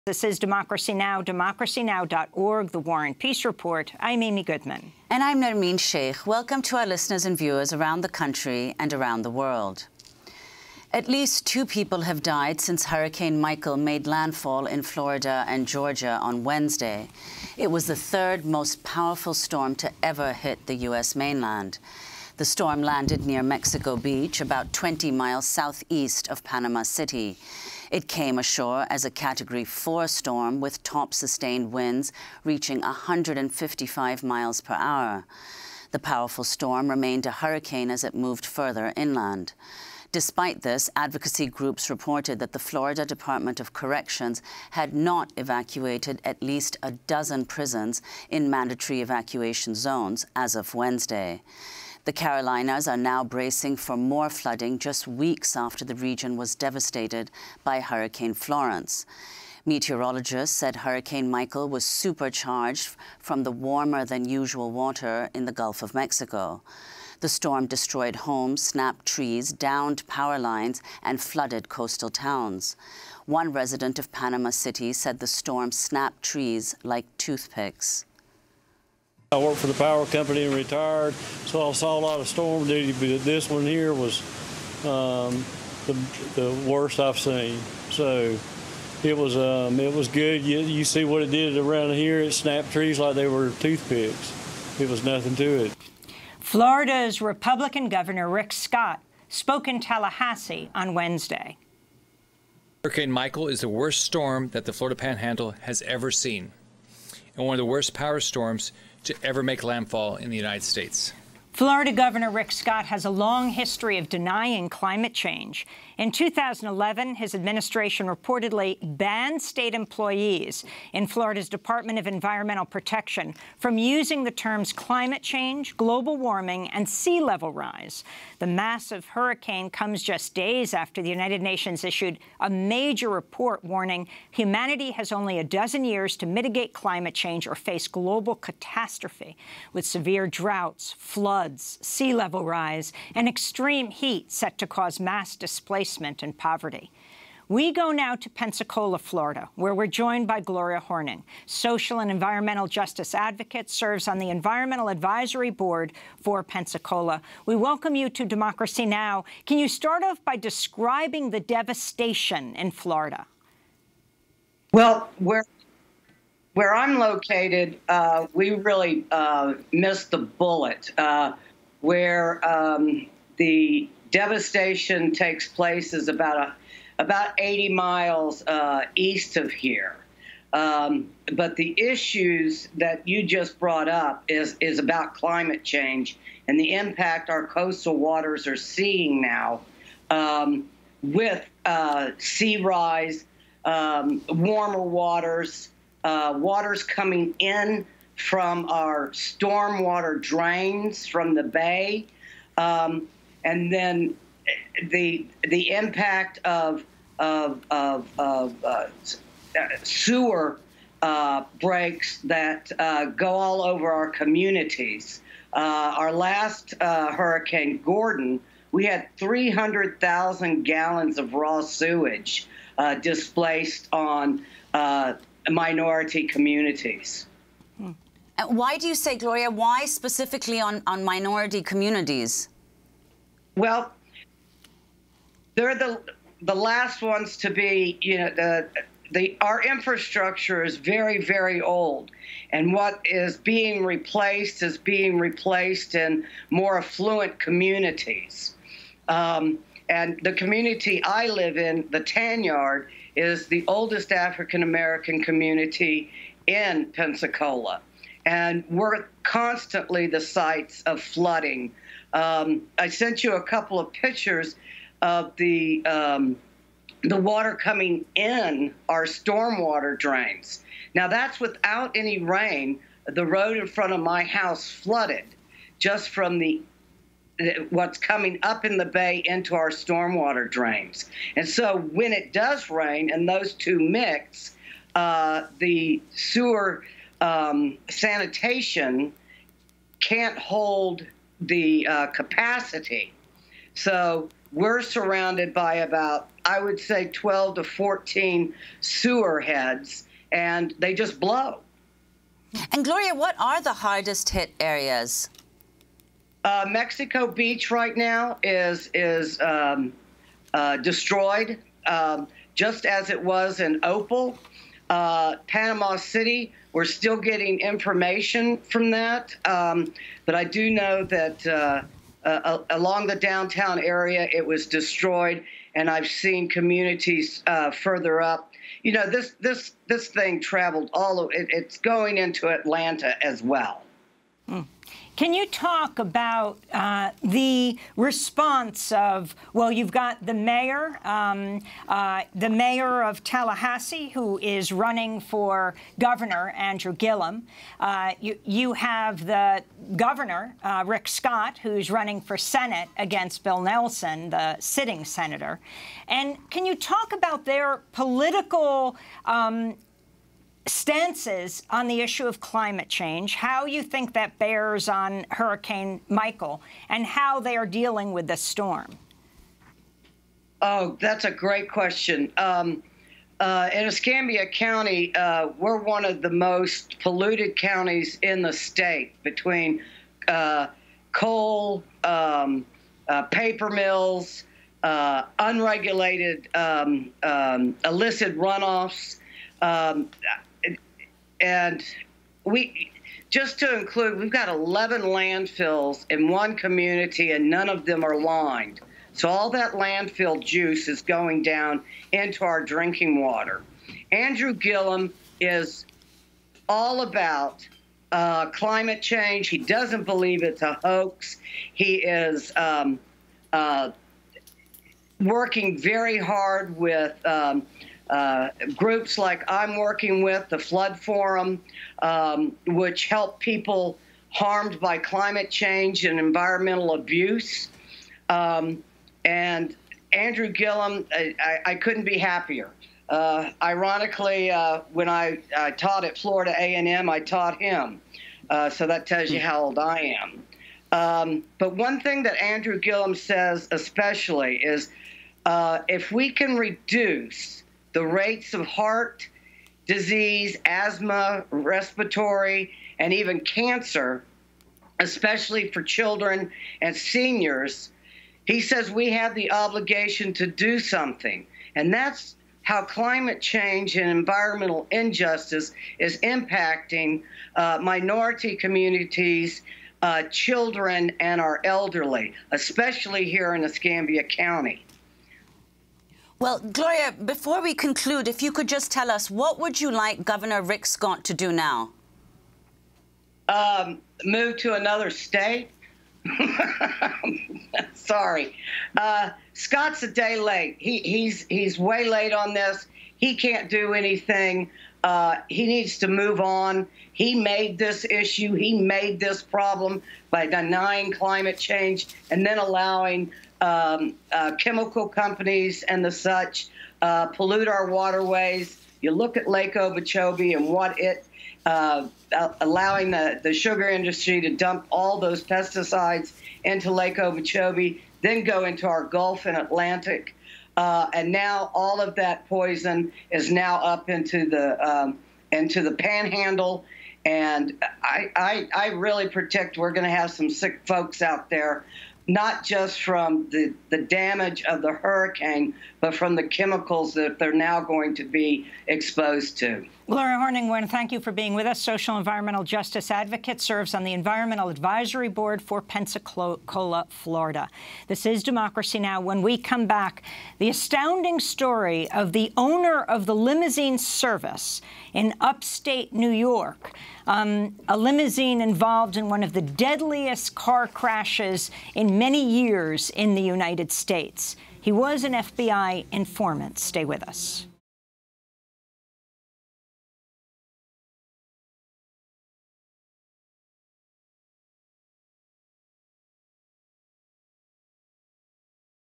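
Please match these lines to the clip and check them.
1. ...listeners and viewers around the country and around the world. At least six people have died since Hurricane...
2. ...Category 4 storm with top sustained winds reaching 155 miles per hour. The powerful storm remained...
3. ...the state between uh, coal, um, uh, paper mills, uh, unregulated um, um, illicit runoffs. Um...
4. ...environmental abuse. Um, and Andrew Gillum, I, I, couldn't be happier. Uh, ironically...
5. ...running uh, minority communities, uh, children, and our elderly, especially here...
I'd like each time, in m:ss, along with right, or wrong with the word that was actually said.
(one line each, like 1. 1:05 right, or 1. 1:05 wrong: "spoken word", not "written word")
1. 0:06 wrong: "two", not "six"
2. 0:29 right
3. 6:18 right
4. 7:06 right
5. 7:46 wrong: "impacting", not "running".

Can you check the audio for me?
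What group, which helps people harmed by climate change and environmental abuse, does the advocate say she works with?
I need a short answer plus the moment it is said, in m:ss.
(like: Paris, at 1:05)
The Flood Forum, at 7:00.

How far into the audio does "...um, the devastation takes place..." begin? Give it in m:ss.
2:52.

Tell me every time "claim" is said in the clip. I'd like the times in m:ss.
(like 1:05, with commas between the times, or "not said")
not said.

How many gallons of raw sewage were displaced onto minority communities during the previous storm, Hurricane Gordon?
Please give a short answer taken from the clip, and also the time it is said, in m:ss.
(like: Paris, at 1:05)
300,000, at 3:39.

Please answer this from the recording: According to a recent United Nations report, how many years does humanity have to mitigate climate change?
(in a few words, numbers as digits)
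A dozen years.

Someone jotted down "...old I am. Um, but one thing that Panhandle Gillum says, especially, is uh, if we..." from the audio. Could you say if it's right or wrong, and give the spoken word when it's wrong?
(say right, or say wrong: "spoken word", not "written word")
wrong: "Andrew", not "Panhandle".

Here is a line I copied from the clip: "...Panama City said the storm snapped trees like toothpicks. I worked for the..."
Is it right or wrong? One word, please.
right.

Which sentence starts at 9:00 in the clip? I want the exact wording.
Gloria Horning, want to thank you for being with us.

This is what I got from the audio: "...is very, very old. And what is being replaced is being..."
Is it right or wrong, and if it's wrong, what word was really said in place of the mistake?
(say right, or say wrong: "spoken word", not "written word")
right.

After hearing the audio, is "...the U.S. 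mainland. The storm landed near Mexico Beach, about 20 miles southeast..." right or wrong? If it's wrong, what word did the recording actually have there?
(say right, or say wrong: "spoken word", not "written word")
right.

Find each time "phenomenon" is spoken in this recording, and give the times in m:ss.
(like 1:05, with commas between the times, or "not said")
not said.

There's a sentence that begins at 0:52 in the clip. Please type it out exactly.
The Carolinas are now bracing for more flooding just weeks after the region was devastated by Hurricane Florence.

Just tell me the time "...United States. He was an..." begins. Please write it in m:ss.
9:23.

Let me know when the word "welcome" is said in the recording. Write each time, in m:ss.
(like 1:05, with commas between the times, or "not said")
0:06, 2:37.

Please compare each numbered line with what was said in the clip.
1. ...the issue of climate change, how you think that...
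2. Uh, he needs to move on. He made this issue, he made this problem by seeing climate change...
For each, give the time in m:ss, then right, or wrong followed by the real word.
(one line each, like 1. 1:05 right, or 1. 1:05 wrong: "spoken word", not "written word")
1. 6:01 right
2. 8:15 wrong: "denying", not "seeing".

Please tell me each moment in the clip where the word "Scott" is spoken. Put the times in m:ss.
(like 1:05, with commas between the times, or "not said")
1:38, 1:52, 5:51, 8:00, 8:09.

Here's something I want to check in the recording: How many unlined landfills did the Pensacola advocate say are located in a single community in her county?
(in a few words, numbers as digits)
11.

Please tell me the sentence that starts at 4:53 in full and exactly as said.
So we're surrounded by about, I would say, 12 to 14 sewer heads, and they just blow.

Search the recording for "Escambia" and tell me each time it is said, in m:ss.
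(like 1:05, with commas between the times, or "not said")
6:13, 7:53.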